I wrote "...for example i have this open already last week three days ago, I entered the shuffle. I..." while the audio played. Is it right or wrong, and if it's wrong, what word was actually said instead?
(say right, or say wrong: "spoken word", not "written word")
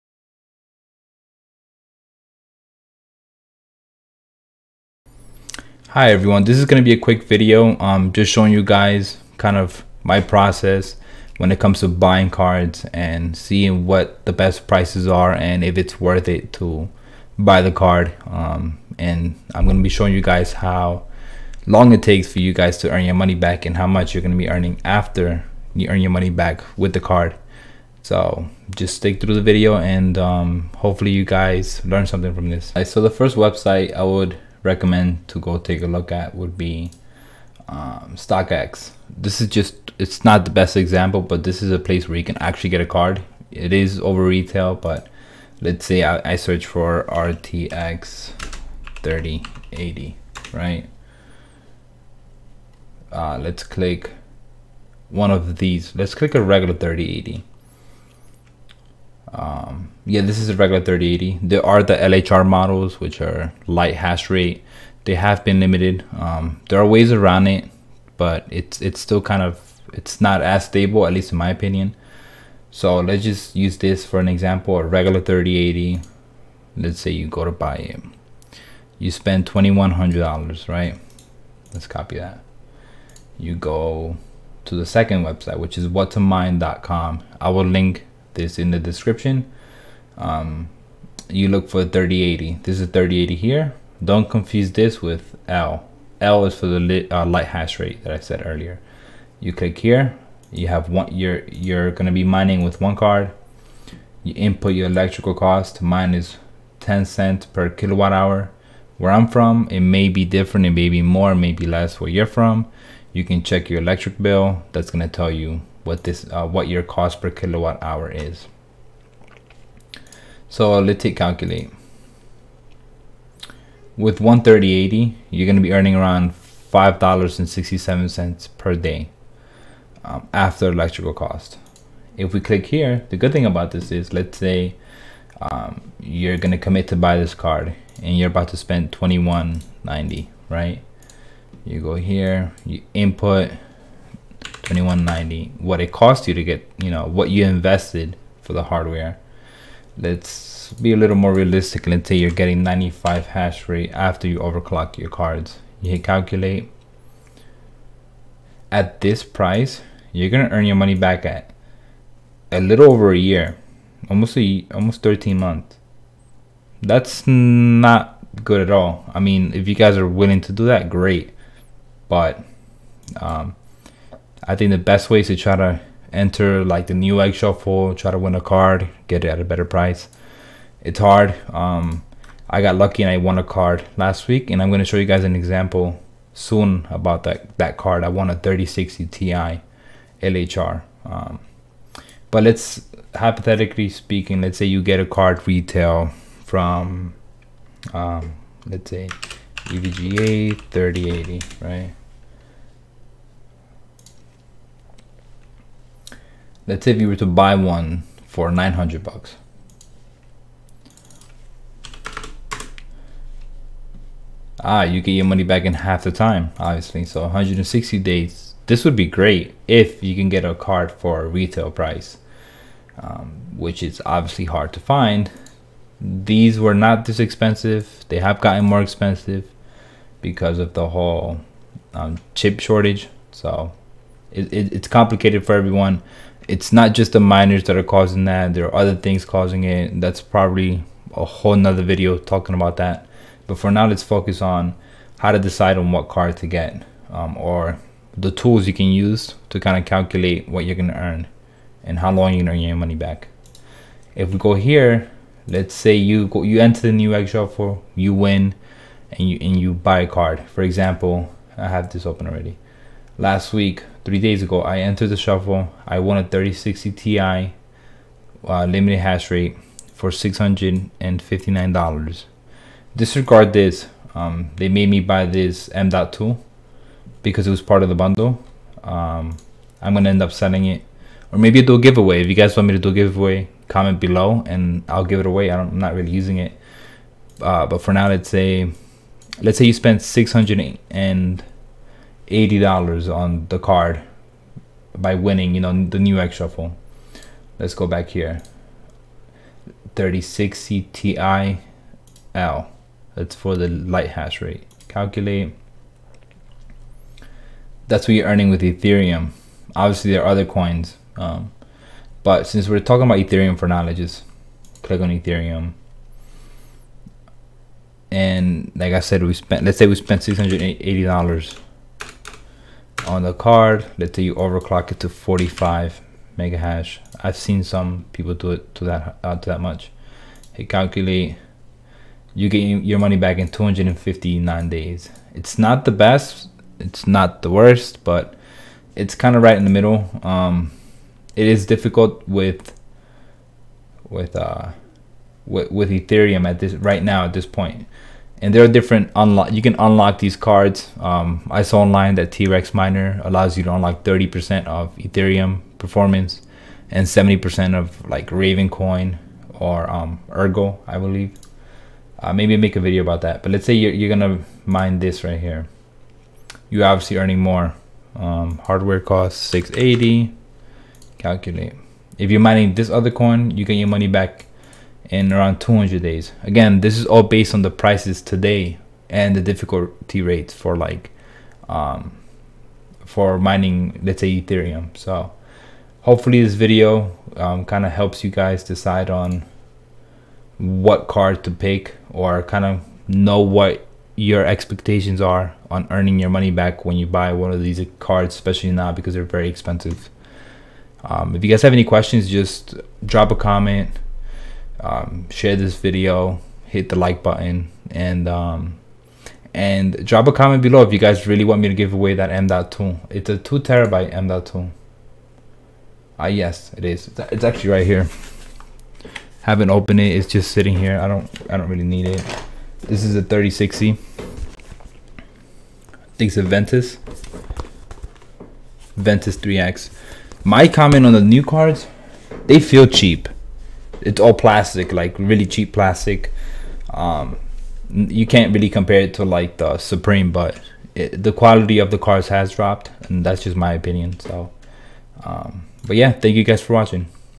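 right.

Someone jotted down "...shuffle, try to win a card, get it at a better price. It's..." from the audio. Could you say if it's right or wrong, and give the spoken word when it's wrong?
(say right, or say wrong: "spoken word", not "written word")
right.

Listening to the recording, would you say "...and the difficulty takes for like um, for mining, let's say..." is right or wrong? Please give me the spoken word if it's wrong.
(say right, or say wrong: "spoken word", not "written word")
wrong: "rates", not "takes".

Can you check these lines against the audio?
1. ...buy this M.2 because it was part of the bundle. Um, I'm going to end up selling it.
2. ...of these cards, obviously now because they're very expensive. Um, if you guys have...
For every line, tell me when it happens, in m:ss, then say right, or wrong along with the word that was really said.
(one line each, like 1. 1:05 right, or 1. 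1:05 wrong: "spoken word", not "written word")
1. 4:34 right
2. 6:37 wrong: "especially", not "obviously".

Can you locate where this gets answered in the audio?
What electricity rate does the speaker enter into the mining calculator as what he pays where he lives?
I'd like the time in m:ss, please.
1:46.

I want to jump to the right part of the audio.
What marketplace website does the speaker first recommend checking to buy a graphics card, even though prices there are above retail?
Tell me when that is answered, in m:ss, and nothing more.
0:38.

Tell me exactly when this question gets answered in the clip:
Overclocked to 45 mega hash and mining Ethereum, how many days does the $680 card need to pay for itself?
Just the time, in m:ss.
5:33.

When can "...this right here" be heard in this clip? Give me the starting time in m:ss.
6:04.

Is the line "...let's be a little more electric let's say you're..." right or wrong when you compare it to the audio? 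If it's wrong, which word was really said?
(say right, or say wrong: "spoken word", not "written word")
wrong: "realistic", not "electric".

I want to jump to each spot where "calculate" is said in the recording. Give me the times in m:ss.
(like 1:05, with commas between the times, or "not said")
2:01, 2:36, 4:09, 5:04, 5:30, 6:11.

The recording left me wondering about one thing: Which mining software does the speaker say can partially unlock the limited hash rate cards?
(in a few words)
T-Rex Miner.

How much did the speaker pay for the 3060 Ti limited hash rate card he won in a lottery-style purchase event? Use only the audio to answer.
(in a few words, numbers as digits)
$659.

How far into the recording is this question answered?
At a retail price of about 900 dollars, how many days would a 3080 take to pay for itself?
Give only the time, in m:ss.
3:37.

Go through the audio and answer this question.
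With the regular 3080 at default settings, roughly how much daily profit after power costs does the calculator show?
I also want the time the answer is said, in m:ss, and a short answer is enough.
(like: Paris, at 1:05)
$5.67, at 2:06.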